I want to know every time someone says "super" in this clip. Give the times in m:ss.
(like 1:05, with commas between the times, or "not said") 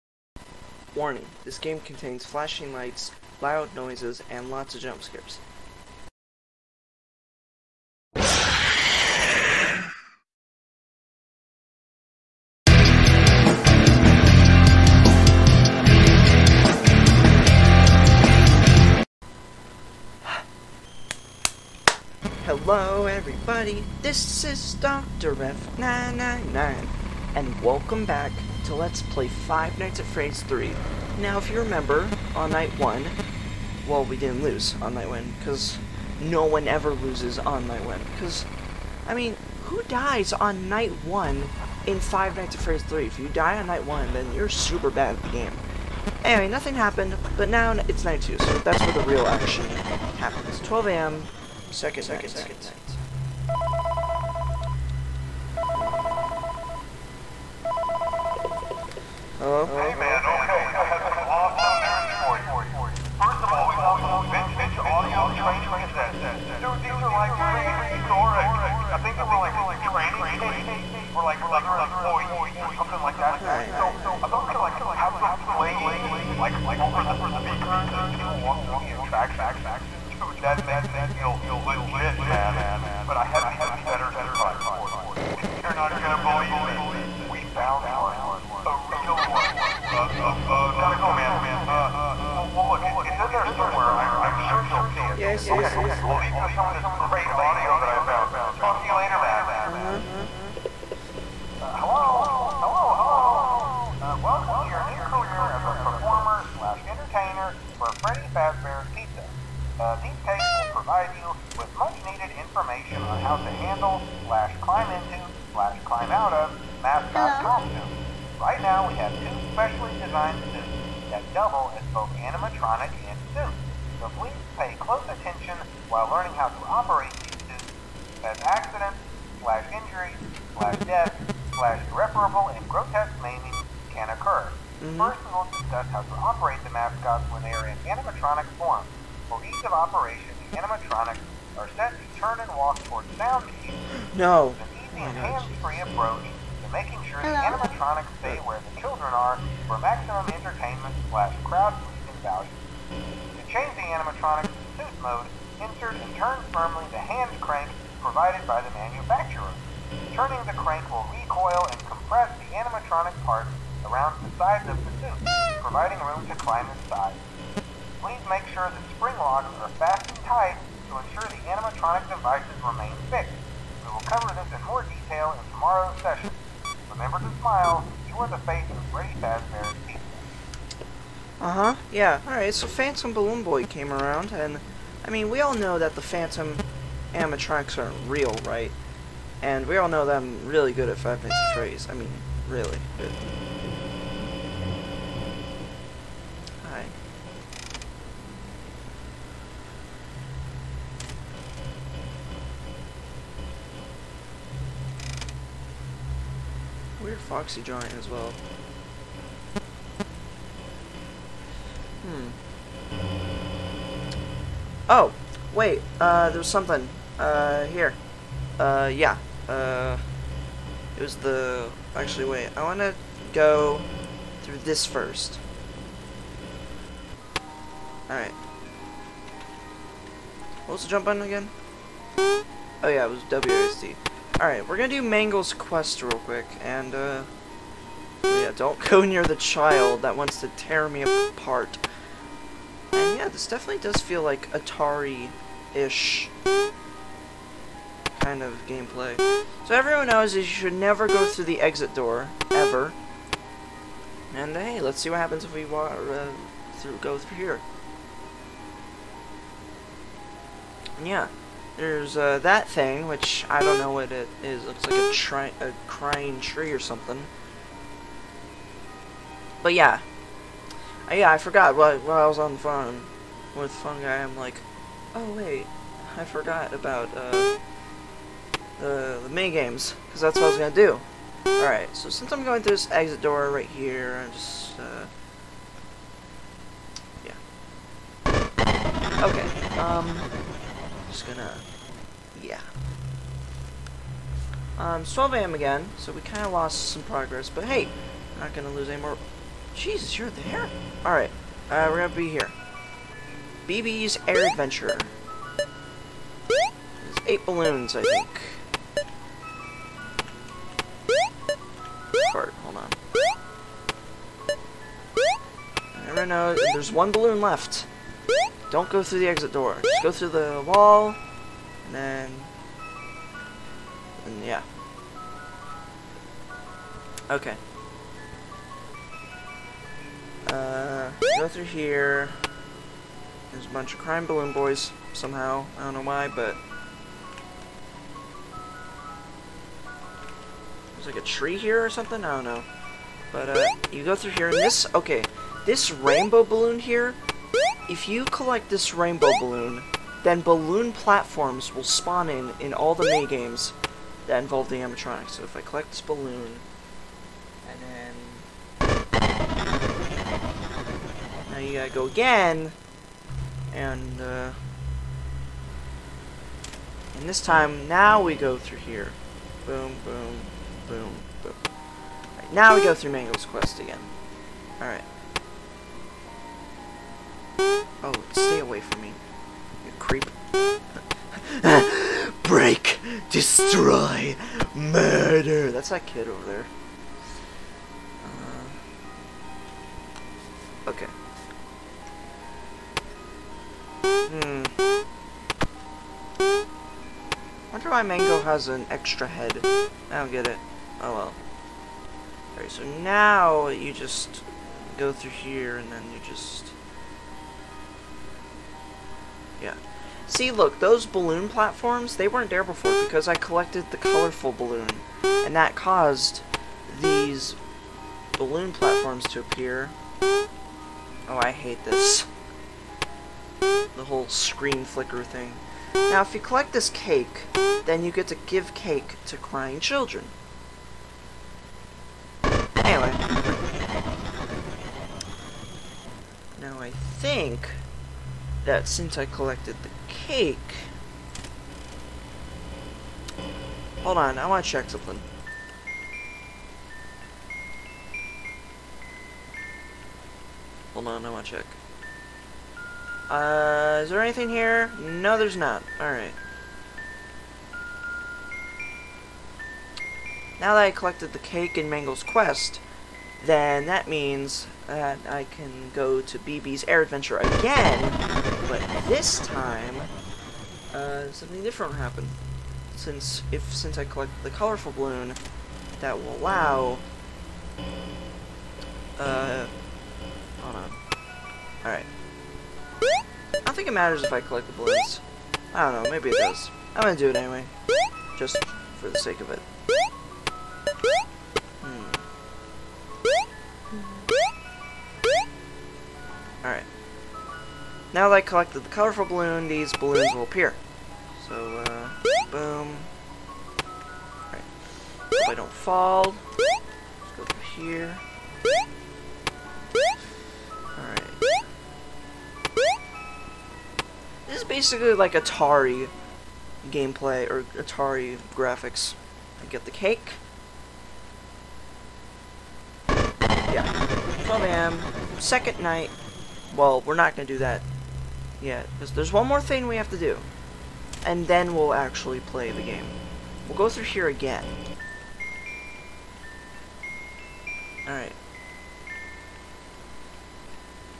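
0:44.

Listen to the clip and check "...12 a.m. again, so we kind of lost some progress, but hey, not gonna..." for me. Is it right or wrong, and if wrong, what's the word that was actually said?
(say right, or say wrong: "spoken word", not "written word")
right.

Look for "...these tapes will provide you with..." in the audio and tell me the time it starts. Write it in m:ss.
1:49.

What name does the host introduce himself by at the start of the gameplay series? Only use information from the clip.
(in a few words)
Dr. F999.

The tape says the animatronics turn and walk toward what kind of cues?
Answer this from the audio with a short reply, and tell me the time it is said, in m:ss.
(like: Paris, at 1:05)
sound cues, at 2:23.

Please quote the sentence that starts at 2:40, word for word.
Turning the crank will recoil and compress the animatronic parts around the sides of the suit, providing room to climb inside.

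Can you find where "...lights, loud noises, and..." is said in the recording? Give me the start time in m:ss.
0:02.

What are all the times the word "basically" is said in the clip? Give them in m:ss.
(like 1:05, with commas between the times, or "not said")
8:34.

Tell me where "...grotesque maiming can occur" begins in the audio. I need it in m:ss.
2:12.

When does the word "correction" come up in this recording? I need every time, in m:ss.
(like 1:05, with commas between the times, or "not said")
not said.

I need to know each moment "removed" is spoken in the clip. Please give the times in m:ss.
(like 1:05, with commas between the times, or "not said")
not said.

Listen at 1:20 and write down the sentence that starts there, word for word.
Dude, that makes this feel legit, man.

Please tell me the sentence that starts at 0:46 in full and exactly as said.
Anyway, nothing happened, but now it's night two, so that's where the real action happens.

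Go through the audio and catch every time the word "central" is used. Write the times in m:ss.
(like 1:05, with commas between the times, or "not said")
not said.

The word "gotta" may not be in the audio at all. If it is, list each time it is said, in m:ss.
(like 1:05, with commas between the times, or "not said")
1:30, 6:01.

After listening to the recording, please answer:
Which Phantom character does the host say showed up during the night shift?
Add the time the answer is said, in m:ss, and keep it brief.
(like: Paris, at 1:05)
Phantom Balloon Boy, at 3:02.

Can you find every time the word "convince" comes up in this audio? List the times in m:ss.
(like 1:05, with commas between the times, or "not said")
not said.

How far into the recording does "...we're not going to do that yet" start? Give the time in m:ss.
8:47.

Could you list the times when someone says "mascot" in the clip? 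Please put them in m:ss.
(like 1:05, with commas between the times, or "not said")
1:56, 2:16.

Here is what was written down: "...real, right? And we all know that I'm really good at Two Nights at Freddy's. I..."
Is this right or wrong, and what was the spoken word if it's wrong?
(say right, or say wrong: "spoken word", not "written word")
wrong: "Five", not "Two".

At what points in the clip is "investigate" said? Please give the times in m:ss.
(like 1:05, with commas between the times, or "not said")
not said.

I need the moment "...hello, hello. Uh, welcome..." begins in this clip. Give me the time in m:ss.
1:42.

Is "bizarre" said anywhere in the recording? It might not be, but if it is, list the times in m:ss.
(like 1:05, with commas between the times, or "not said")
not said.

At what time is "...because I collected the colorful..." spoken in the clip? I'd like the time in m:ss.
6:53.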